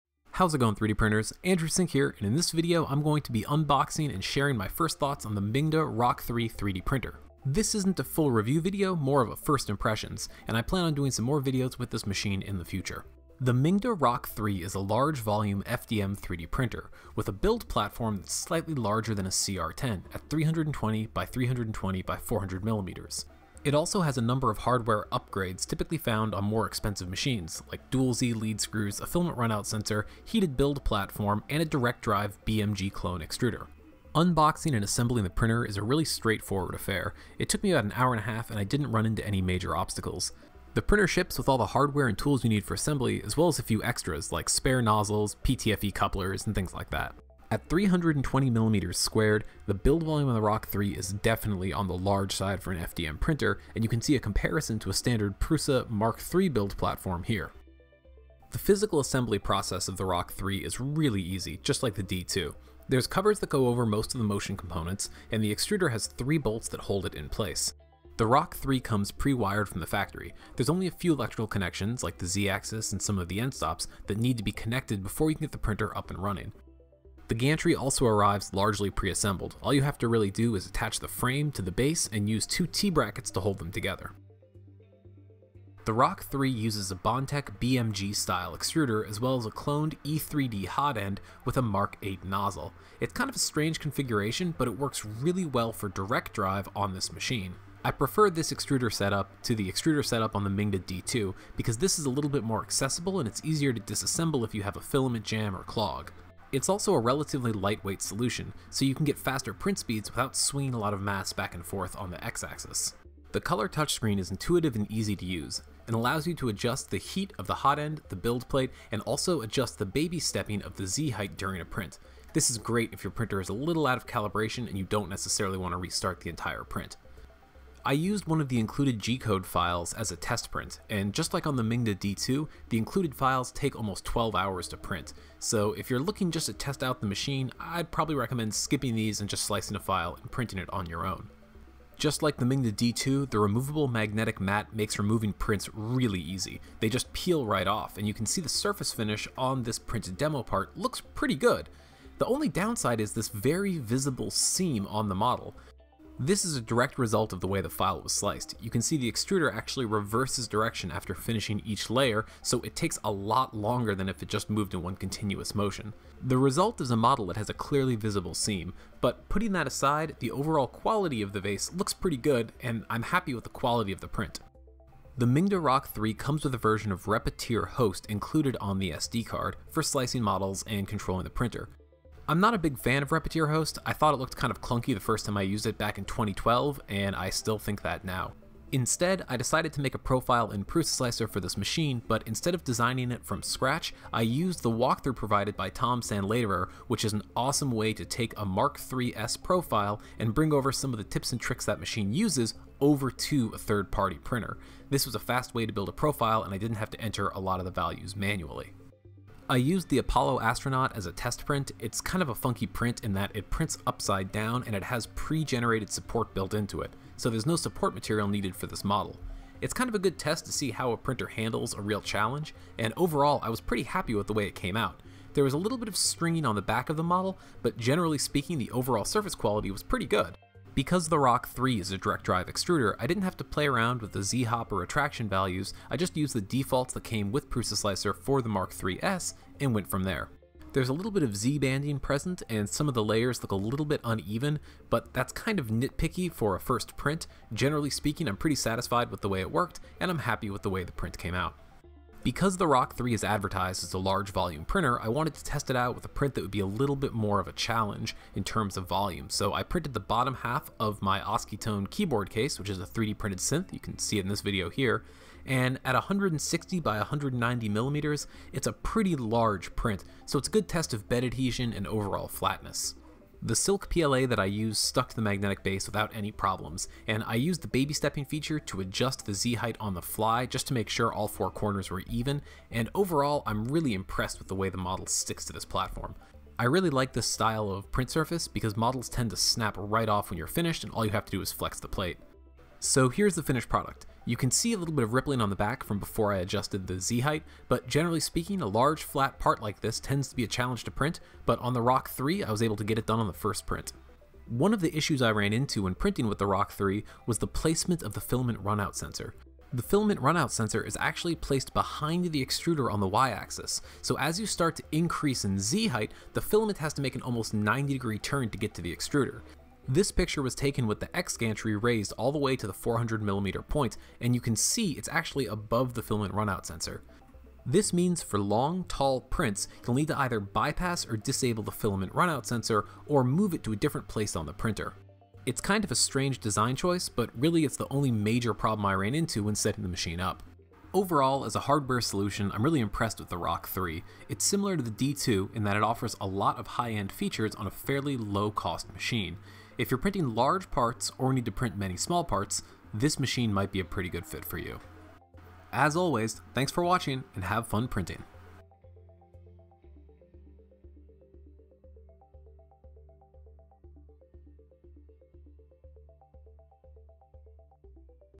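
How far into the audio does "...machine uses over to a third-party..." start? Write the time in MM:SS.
03:21.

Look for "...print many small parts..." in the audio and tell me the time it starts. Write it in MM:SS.
05:51.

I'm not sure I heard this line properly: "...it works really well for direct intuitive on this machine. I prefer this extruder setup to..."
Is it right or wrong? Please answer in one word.
wrong.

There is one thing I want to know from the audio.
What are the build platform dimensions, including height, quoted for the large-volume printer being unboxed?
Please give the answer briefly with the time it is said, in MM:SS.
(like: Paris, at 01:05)
320 by 320 by 400 millimeters, at 00:20.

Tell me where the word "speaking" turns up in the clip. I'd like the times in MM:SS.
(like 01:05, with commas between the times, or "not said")
03:48, 04:07, 04:58.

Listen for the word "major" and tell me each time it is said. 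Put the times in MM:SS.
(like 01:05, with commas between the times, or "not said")
00:39, 05:38.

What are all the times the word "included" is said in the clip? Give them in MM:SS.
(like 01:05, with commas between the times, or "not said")
02:08, 02:12, 02:58.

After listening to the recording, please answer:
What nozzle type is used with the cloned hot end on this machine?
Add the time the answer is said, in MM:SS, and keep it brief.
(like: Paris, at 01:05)
Mark 8, at 01:31.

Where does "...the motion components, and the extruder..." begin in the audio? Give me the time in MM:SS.
01:04.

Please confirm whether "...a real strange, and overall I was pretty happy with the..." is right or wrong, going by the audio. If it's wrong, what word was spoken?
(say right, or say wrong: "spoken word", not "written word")
wrong: "challenge", not "strange".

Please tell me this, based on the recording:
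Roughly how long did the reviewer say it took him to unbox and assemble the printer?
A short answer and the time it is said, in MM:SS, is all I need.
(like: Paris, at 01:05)
an hour and a half, at 00:37.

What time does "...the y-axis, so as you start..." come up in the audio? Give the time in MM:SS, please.
05:12.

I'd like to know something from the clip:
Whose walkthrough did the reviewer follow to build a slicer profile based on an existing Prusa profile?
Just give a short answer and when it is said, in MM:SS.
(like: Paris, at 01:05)
Tom Sanladerer, at 03:15.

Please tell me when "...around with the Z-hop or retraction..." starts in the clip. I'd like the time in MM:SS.
03:53.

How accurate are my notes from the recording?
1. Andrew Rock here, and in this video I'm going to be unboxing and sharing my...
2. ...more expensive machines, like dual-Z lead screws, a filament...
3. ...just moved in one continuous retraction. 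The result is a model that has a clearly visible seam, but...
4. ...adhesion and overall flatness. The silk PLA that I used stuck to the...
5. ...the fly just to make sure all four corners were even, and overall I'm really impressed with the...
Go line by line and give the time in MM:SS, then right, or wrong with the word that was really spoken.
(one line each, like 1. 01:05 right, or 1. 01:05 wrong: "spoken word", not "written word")
1. 00:01 wrong: "Sink", not "Rock"
2. 00:26 right
3. 02:44 wrong: "motion", not "retraction"
4. 04:31 right
5. 04:39 right.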